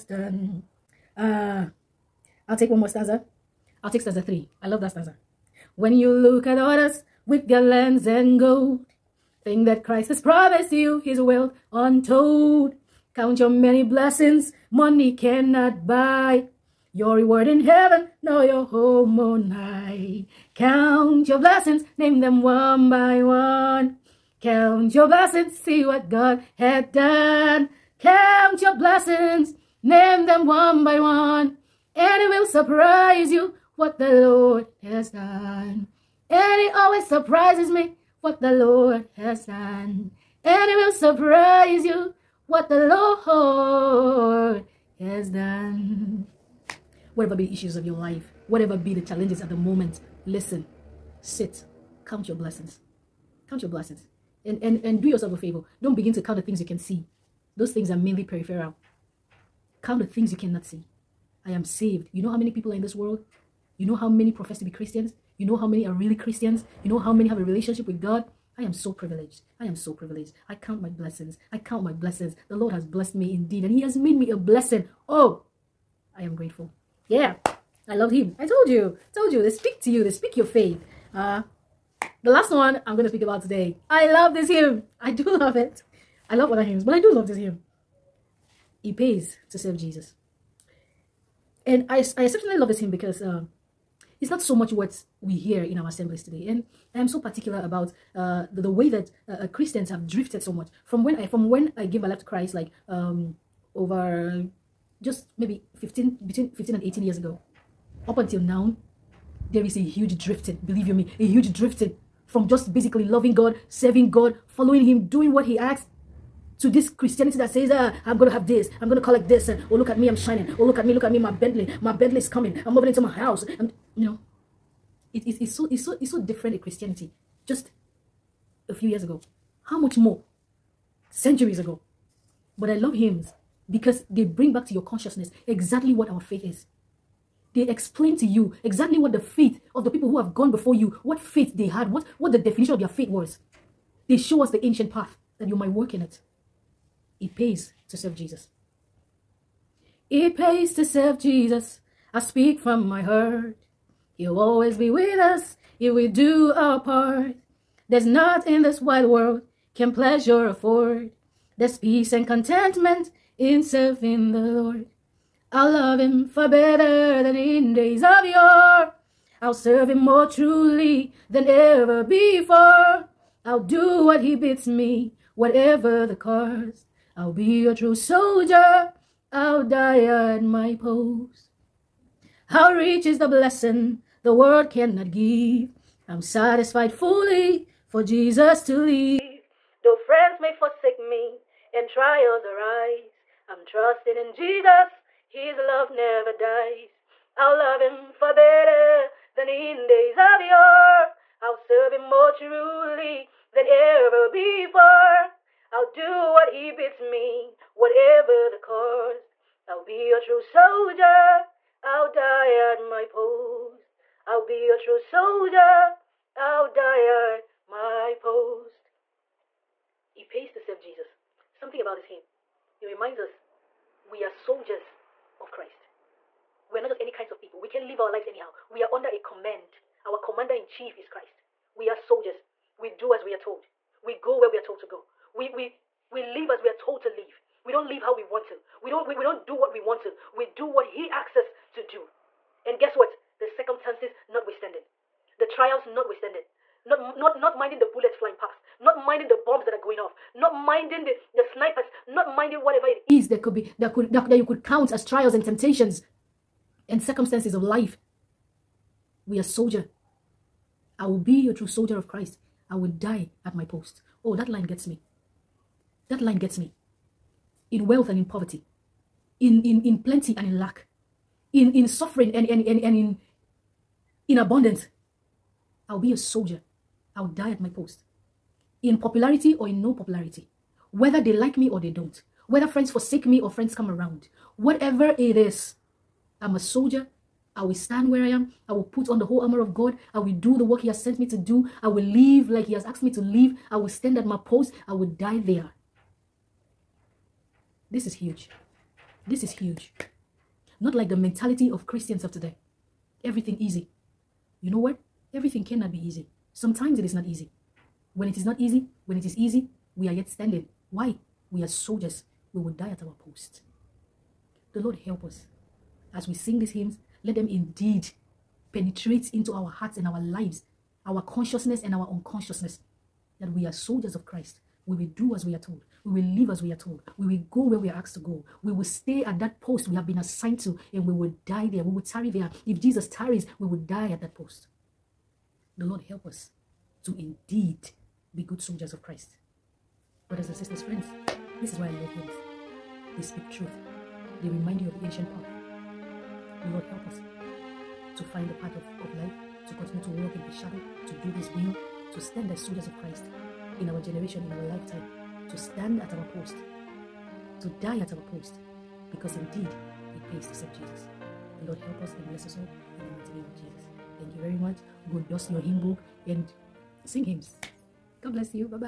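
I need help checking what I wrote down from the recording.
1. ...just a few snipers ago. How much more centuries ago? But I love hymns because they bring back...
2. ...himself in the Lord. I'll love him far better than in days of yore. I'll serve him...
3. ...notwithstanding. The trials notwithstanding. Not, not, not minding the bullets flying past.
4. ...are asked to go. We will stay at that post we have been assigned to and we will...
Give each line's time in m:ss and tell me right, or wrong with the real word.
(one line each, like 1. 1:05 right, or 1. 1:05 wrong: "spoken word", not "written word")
1. 2:07 wrong: "years", not "snipers"
2. 2:43 right
3. 4:04 right
4. 5:27 right.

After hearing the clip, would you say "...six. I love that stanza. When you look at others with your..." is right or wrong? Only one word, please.
wrong.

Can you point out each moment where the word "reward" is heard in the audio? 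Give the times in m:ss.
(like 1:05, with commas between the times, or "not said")
0:17.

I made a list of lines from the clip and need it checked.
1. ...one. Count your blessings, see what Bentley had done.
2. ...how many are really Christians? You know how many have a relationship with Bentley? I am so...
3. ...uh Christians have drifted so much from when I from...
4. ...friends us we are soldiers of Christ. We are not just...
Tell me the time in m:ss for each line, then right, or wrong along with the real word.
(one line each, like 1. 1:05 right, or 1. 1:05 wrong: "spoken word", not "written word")
1. 0:23 wrong: "God", not "Bentley"
2. 1:05 wrong: "God", not "Bentley"
3. 1:39 right
4. 3:42 wrong: "reminds", not "friends".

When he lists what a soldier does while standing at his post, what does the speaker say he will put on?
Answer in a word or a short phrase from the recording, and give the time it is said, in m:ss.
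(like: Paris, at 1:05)
The whole armor of God, at 4:49.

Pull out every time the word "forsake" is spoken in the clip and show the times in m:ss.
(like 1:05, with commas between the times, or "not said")
3:10, 4:42.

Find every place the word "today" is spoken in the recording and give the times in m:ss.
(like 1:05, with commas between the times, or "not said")
1:23, 1:36, 5:02.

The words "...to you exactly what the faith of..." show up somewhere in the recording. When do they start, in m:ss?
2:18.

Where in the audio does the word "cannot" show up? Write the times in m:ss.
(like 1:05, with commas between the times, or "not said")
0:15, 1:00, 3:04, 5:05.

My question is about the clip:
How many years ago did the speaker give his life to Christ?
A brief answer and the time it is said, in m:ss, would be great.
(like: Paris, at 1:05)
18 years, at 1:46.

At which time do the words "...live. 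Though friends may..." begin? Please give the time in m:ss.
3:08.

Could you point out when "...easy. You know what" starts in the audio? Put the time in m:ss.
5:03.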